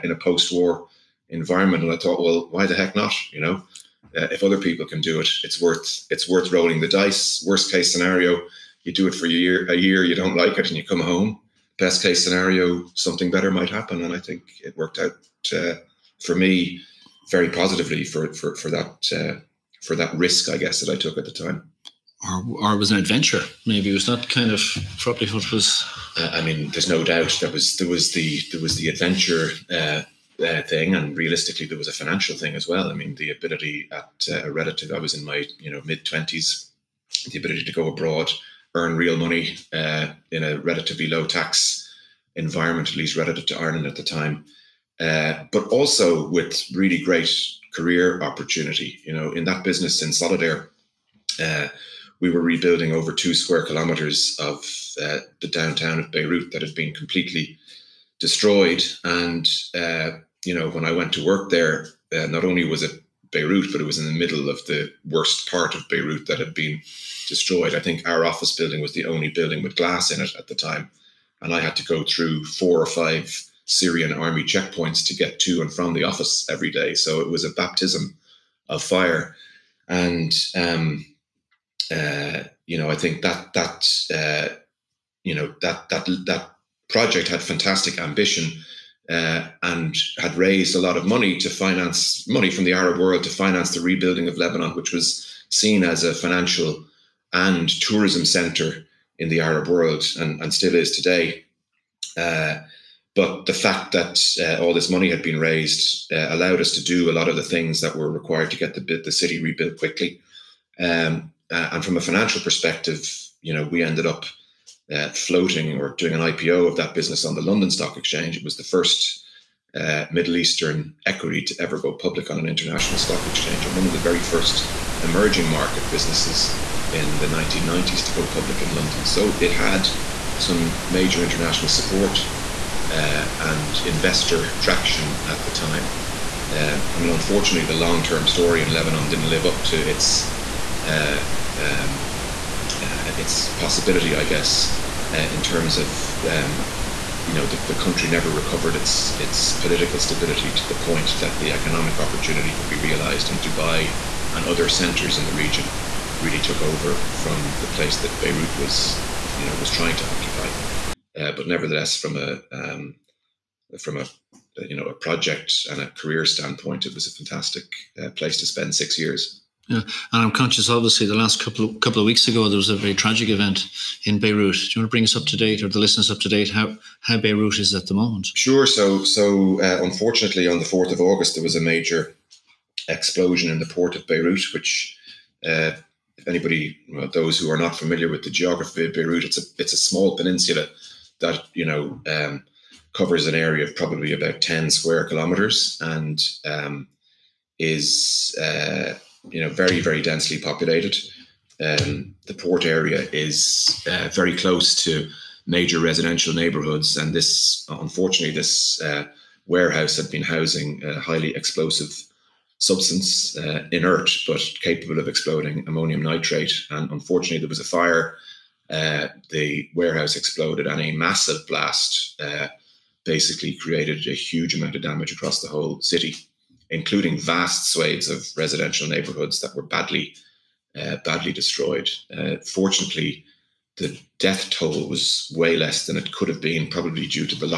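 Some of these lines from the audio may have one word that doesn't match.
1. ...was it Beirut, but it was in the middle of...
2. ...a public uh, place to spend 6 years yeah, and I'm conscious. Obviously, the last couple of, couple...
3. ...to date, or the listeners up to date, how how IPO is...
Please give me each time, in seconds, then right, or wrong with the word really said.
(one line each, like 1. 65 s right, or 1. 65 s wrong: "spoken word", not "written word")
1. 62 s right
2. 167 s wrong: "fantastic", not "public"
3. 175 s wrong: "Beirut", not "IPO".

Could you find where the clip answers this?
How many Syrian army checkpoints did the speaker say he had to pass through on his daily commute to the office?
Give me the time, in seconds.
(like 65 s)
72 s.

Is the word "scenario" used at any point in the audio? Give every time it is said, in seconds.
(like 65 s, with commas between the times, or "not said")
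7 s, 12 s.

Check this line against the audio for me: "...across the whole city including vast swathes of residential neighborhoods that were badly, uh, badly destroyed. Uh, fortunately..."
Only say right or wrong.
right.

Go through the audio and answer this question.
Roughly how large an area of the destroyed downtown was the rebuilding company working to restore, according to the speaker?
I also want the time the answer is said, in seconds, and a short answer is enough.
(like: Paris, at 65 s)
2 square kilometers, at 53 s.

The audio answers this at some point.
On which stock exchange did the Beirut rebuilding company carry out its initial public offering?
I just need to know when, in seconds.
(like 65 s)
117 s.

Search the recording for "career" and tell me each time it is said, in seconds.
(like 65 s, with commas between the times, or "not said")
47 s, 165 s.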